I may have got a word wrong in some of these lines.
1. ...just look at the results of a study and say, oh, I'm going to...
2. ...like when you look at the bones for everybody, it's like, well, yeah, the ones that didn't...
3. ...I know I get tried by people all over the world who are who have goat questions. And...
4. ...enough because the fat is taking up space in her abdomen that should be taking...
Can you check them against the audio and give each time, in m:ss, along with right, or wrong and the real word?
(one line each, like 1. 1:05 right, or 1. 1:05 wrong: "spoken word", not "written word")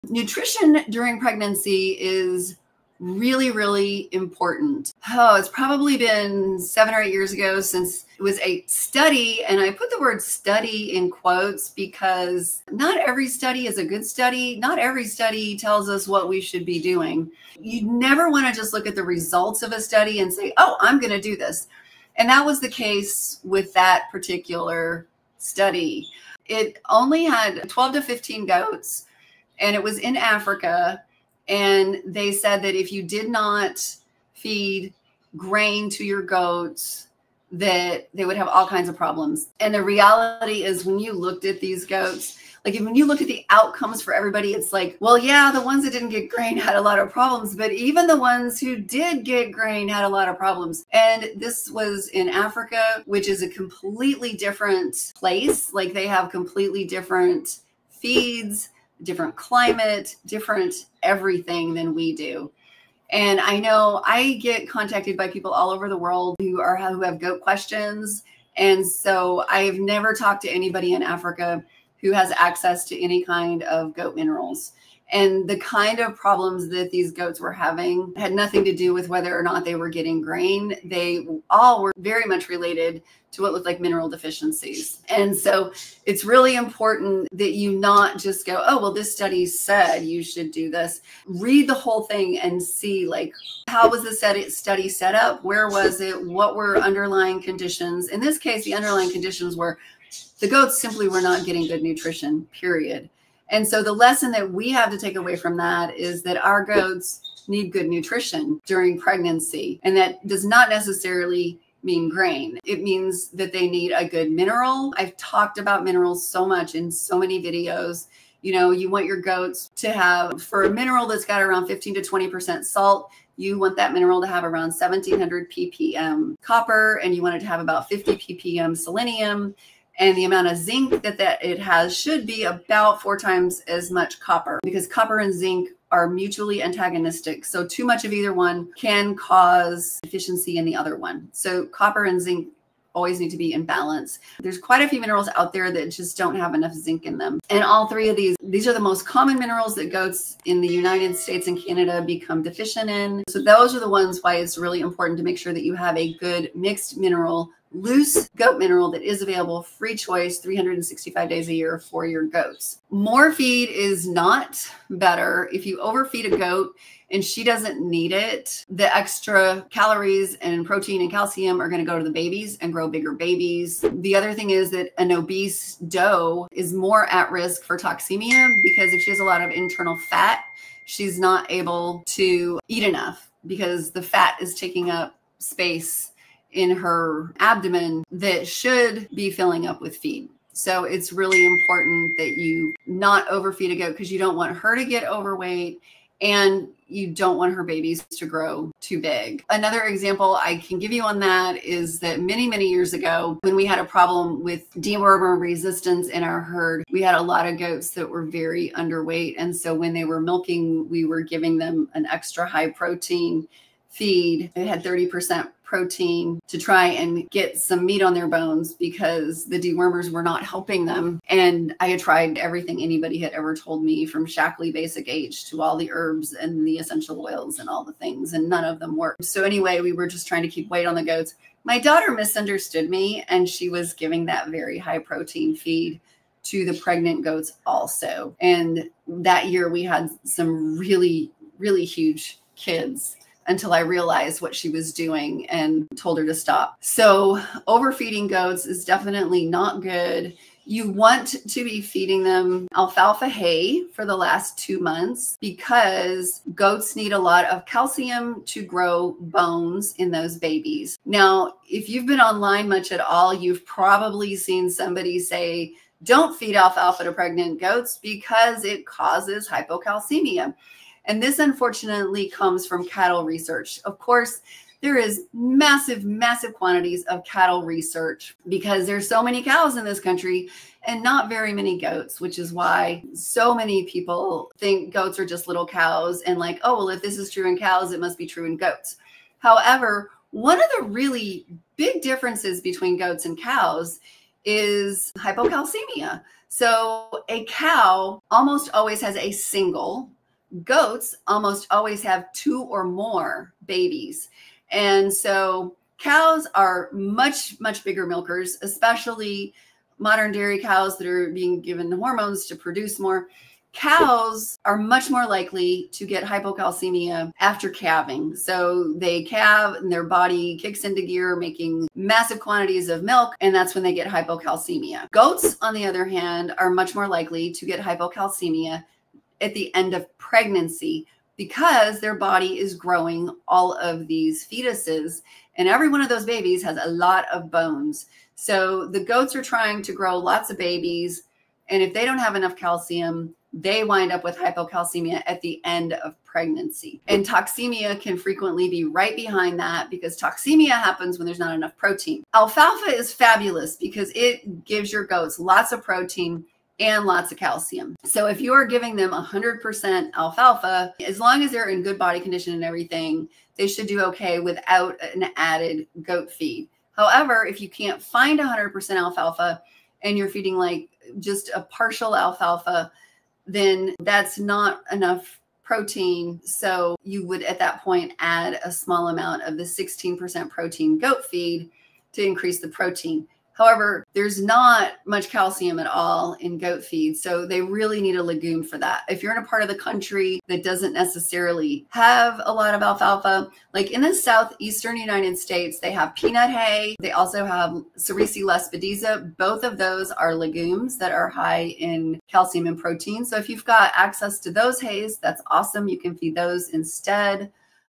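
1. 0:18 right
2. 0:42 wrong: "outcomes", not "bones"
3. 1:03 wrong: "contacted", not "tried"
4. 3:02 wrong: "filling", not "taking".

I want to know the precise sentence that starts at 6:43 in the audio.
So if you've got access to those hays, that's awesome.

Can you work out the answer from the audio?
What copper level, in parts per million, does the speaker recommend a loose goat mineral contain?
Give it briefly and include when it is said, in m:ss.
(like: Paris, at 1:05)
1700 ppm, at 2:04.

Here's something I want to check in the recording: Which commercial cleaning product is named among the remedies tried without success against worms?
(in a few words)
Shaklee Basic H.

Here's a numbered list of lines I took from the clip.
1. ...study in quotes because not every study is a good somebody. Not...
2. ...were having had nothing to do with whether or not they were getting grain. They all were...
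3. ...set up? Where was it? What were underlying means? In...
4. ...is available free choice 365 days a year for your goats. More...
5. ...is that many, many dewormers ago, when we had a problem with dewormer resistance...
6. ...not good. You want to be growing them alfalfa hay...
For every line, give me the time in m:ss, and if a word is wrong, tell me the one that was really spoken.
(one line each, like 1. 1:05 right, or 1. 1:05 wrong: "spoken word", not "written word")
1. 0:10 wrong: "study", not "somebody"
2. 1:17 right
3. 1:34 wrong: "conditions", not "means"
4. 2:39 right
5. 3:21 wrong: "years", not "dewormers"
6. 4:09 wrong: "feeding", not "growing".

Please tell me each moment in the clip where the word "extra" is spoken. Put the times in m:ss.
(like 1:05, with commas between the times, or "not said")
2:48, 3:32.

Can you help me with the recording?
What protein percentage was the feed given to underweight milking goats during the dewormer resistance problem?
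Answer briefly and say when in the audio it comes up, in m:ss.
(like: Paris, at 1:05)
30%, at 3:34.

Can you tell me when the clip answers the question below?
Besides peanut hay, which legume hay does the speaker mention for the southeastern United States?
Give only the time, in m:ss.
6:37.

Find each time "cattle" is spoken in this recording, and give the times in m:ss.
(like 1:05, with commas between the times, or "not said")
4:32, 4:37.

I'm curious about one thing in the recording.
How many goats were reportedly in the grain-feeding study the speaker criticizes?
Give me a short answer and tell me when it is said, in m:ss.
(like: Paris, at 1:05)
12 to 15, at 0:27.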